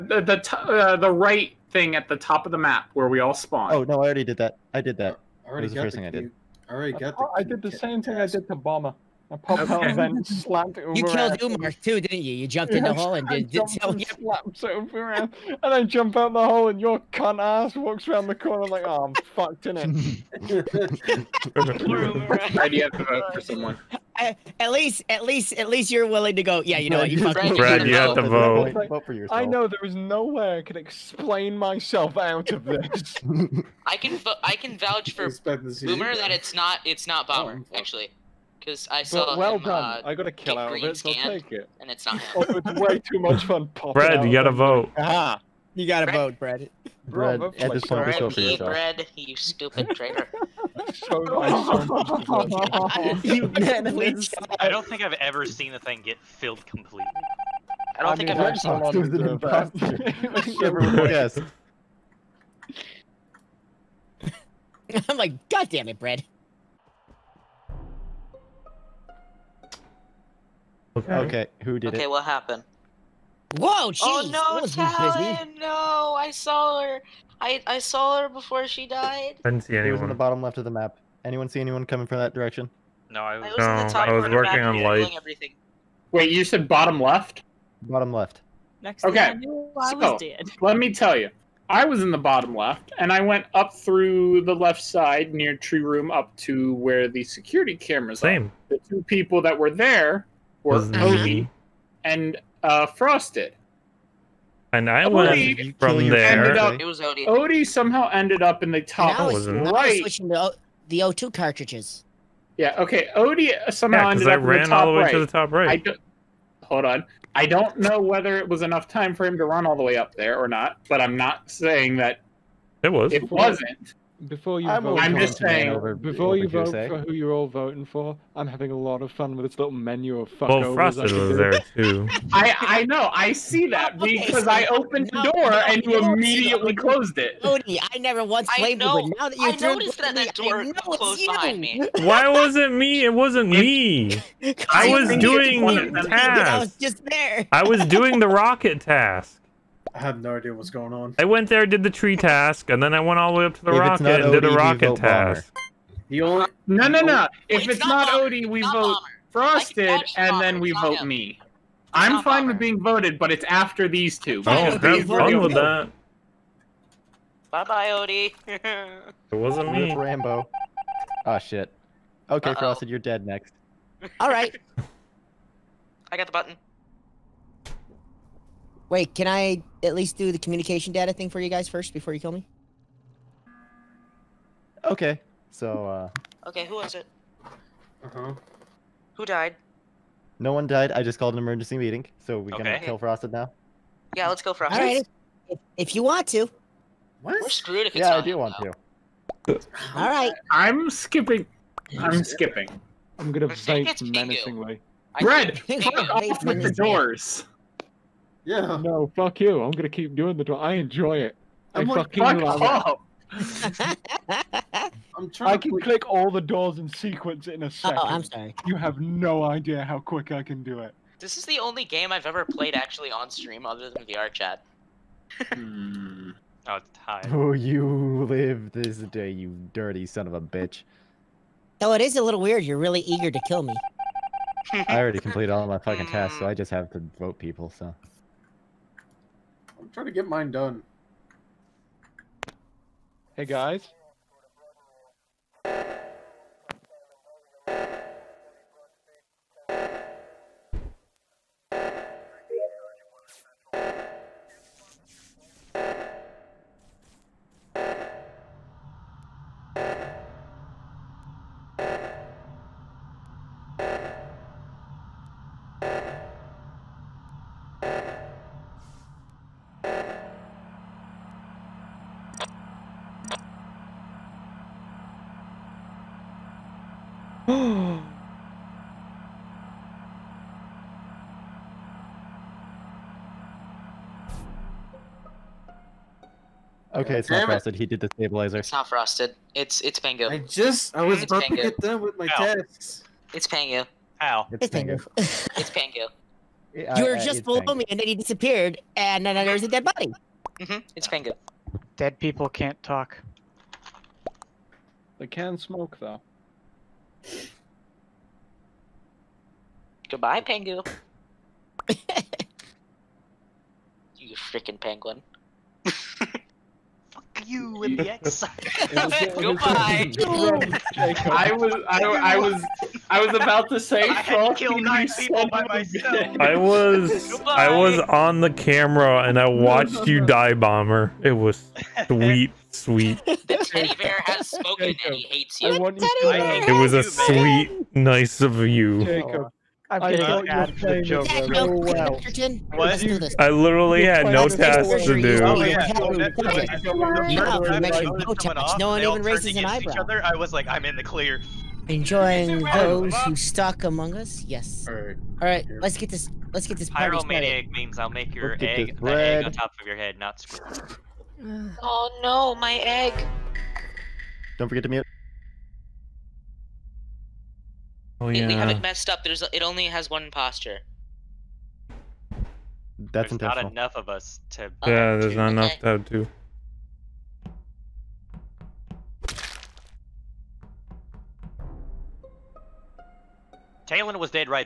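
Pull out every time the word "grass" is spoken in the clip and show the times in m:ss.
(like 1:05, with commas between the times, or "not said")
not said.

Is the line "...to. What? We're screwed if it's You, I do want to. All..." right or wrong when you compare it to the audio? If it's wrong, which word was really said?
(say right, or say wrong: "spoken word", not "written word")
wrong: "Yeah", not "You".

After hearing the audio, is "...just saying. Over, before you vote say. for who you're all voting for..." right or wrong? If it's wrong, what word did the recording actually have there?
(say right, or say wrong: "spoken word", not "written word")
right.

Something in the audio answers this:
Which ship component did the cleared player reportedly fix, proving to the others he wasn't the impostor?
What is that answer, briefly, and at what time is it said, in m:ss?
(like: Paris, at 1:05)
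stabilizer, at 4:48.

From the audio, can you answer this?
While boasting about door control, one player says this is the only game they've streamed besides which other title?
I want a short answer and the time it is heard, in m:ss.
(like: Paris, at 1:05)
VR chat, at 3:44.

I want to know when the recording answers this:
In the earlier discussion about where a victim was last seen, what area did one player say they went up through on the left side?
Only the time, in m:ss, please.
1:35.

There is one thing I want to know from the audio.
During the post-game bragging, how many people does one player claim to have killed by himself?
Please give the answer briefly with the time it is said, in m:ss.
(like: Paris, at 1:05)
9, at 5:24.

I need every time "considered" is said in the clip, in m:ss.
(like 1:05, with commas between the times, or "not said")
not said.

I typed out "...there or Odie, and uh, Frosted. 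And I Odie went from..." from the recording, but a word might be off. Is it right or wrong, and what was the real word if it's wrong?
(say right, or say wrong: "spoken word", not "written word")
right.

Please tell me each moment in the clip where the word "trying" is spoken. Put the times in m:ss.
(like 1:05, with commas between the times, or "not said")
3:35, 3:59.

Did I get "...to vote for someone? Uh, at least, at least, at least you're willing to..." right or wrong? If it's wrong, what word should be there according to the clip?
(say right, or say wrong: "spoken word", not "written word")
right.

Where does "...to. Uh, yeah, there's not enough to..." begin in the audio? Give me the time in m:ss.
6:14.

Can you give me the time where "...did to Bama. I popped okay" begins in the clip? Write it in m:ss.
0:08.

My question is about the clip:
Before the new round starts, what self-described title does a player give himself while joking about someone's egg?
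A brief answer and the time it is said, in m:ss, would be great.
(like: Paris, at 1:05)
Pyromaniac, at 5:57.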